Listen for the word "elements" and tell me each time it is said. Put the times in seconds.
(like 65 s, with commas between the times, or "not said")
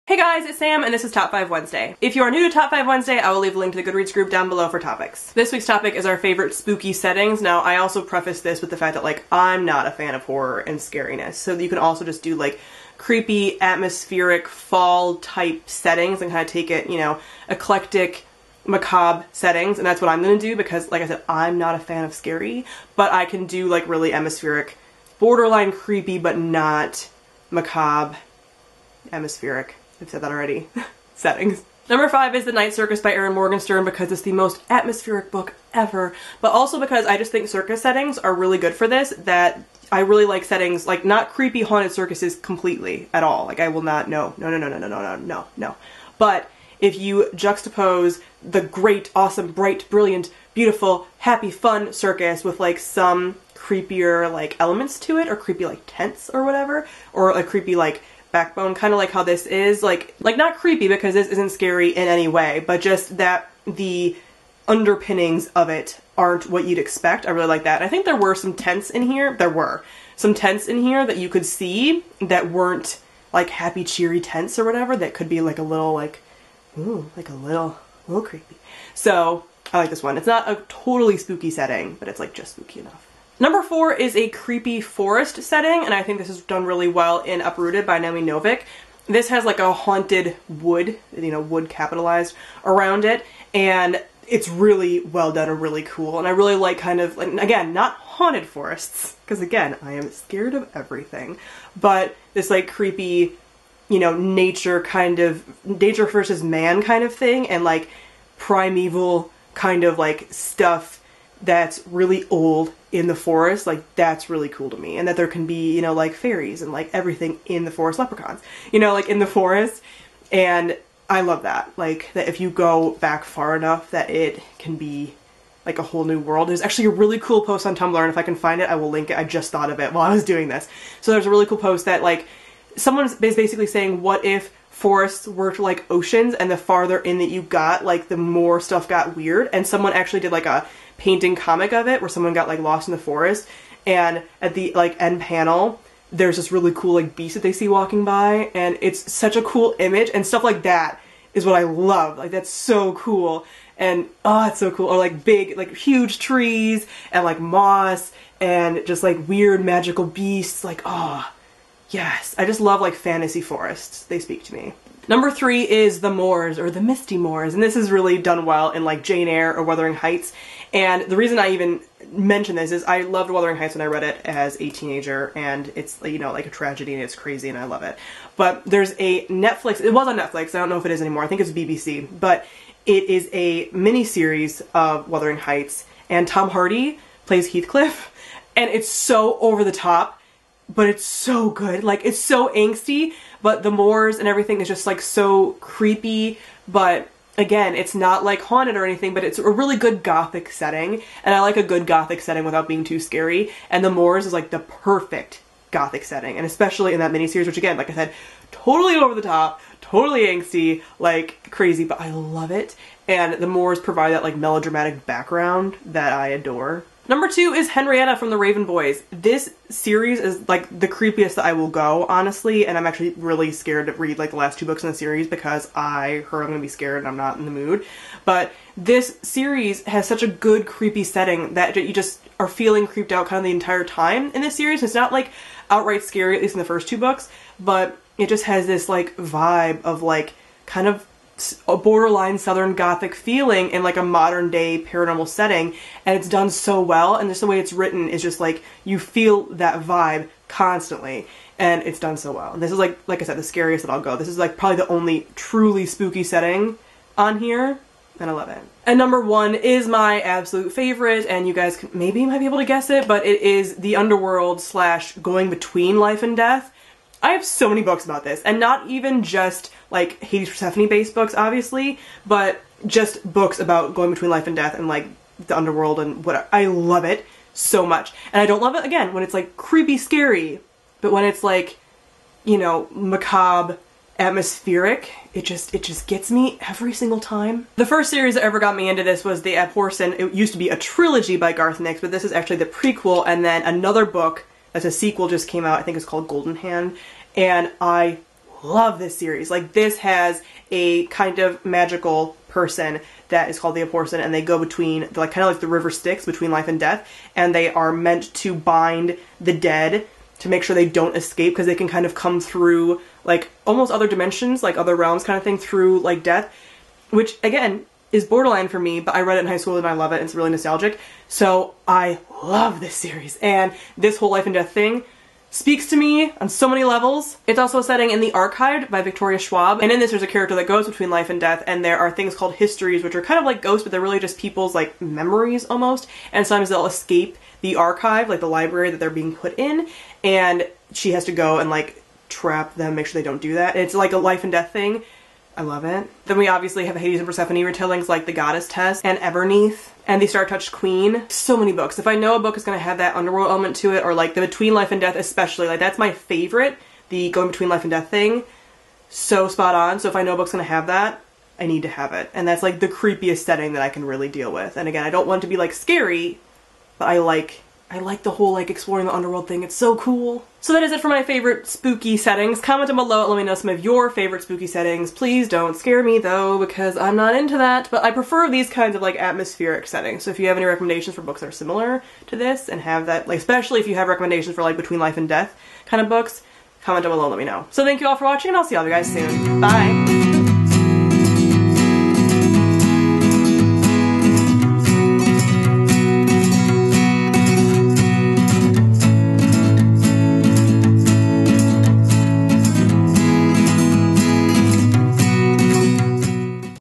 54 s, 353 s.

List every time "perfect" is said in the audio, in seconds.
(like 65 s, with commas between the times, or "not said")
204 s.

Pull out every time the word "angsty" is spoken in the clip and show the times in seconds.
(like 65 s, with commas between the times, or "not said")
192 s, 210 s.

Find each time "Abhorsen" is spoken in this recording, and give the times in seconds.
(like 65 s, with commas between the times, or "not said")
289 s, 303 s.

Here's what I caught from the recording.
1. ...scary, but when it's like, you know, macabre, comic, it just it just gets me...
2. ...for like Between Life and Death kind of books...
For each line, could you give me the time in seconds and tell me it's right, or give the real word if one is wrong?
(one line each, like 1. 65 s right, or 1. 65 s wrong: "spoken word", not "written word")
1. 279 s wrong: "atmospheric", not "comic"
2. 384 s right.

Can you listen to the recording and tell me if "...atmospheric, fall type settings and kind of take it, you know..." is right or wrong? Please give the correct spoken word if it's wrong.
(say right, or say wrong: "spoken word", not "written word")
right.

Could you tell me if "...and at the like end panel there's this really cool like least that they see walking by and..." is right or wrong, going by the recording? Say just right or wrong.
wrong.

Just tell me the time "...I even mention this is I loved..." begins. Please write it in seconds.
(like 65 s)
171 s.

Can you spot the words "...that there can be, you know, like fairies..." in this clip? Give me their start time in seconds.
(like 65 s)
115 s.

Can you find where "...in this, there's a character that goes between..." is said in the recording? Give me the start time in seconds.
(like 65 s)
329 s.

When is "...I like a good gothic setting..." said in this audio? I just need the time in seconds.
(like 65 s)
201 s.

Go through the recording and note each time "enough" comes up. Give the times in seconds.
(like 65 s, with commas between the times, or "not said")
82 s, 123 s.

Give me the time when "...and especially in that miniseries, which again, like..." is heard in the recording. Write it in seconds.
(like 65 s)
206 s.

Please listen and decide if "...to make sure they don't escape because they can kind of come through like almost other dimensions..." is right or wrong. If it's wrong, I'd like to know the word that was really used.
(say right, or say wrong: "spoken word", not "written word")
right.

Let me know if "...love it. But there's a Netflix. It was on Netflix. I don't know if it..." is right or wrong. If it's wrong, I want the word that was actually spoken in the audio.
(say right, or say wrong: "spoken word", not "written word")
right.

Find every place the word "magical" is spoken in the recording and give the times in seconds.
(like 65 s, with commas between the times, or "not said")
159 s, 301 s.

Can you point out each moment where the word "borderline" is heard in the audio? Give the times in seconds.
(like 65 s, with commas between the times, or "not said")
25 s, 241 s, 318 s.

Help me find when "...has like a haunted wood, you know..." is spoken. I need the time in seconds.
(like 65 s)
89 s.